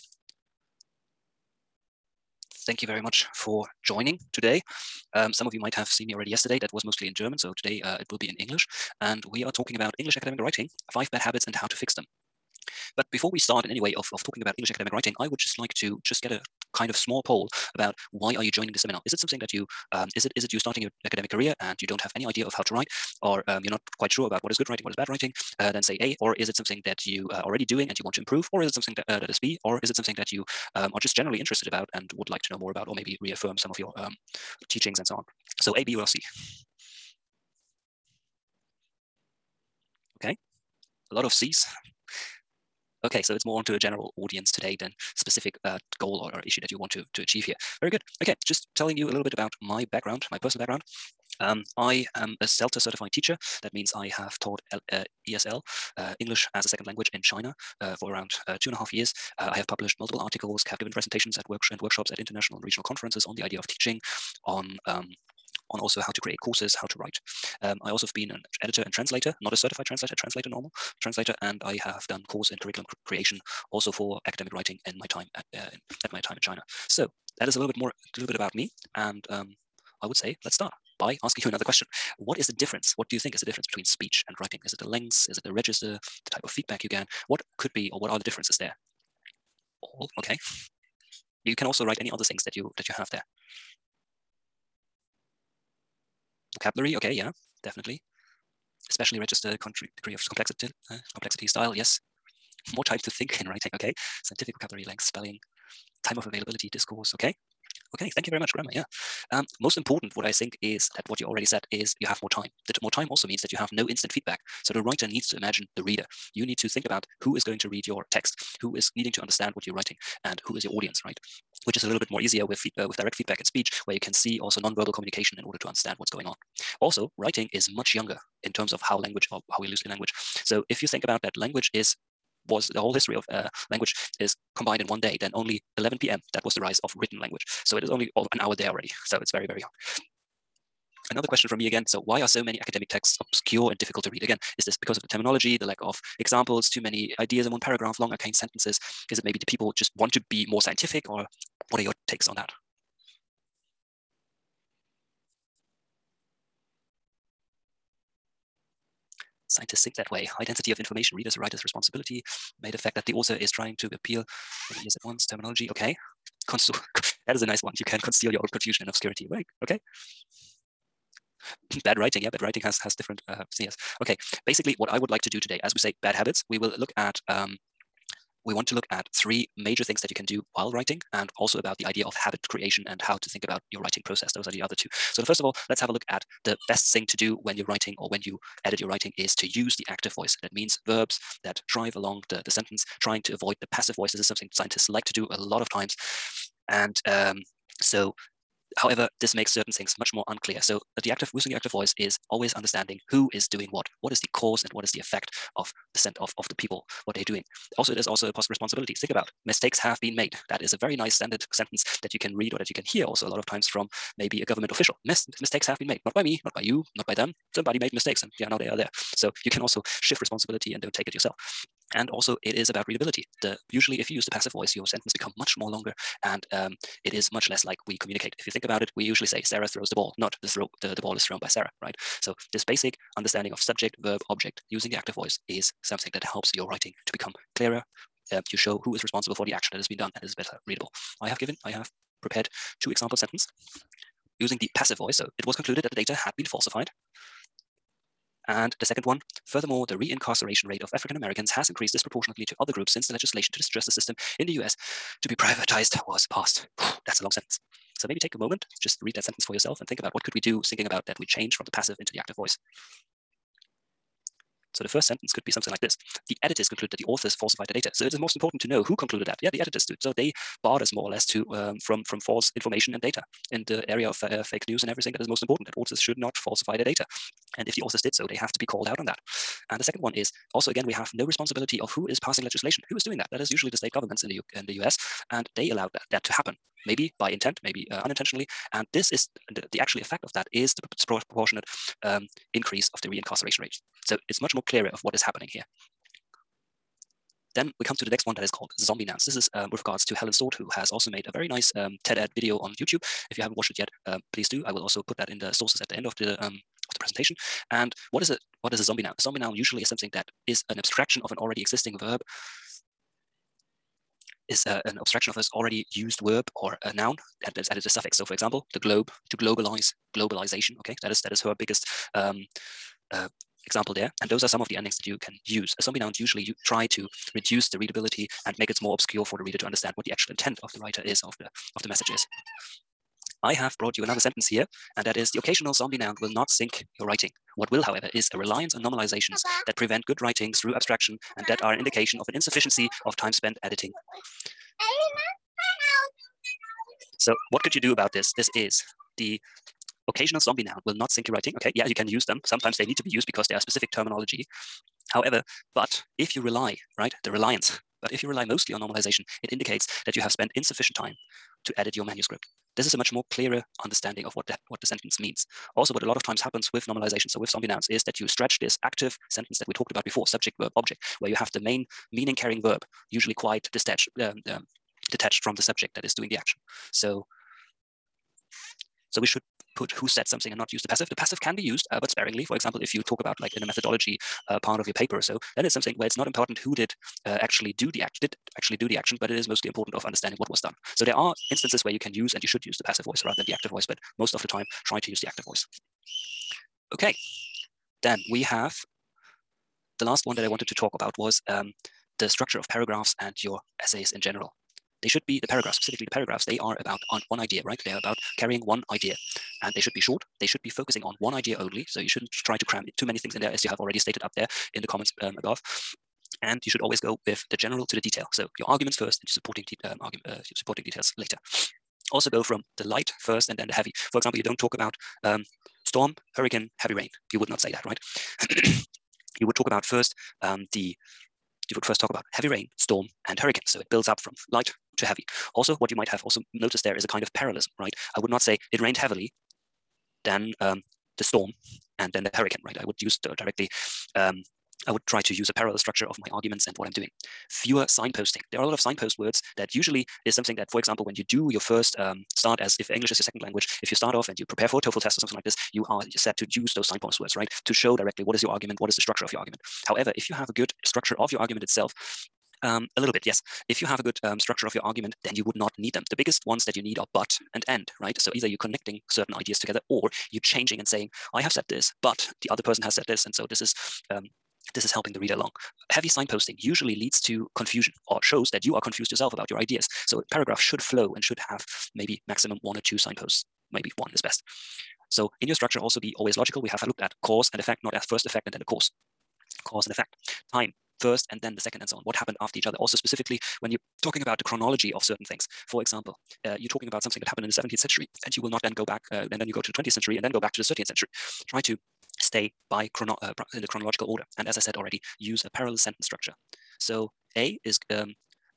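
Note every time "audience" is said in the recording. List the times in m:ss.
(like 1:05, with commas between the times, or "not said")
0:44, 2:00.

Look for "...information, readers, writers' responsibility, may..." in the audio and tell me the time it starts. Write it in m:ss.
2:40.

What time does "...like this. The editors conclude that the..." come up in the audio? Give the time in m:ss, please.
4:25.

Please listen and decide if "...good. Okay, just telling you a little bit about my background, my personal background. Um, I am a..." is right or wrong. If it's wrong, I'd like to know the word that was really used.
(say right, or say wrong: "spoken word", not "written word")
right.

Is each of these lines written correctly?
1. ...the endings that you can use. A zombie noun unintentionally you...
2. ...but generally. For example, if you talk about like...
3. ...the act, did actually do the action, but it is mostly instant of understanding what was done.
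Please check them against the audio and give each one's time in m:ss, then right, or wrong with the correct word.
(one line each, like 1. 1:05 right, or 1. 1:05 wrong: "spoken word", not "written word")
1. 5:24 wrong: "usually", not "unintentionally"
2. 6:21 wrong: "sparingly", not "generally"
3. 6:27 wrong: "important", not "instant".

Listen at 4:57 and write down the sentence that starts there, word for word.
Then we come to the next one that is called Zombie Nouns.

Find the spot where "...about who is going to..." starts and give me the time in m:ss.
1:56.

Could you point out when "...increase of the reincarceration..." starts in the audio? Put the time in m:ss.
4:52.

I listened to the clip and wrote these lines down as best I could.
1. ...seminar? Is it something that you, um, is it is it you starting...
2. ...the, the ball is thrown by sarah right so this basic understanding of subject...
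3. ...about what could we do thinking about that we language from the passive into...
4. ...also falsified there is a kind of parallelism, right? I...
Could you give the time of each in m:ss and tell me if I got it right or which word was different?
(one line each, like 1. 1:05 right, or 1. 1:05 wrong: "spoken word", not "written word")
1. 0:18 right
2. 3:50 right
3. 4:19 wrong: "change", not "language"
4. 7:16 wrong: "noticed", not "falsified".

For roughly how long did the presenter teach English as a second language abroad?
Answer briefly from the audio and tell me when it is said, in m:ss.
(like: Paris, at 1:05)
Two and a half years, at 0:58.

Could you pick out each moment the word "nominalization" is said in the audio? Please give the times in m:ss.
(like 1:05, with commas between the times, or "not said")
5:38, 5:58, 6:06.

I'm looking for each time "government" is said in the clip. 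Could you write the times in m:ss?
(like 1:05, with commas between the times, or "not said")
3:34, 4:43.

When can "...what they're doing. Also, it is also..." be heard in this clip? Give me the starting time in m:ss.
3:27.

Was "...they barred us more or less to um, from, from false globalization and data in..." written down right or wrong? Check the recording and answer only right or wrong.
wrong.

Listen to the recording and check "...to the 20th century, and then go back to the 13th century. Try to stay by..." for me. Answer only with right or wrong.
right.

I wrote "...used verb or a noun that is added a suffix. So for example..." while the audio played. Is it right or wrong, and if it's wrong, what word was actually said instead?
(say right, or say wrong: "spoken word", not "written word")
right.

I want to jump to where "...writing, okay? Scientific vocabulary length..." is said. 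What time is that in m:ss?
1:43.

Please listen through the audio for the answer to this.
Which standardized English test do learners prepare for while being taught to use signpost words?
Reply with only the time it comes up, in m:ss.
7:34.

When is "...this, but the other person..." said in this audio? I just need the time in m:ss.
7:51.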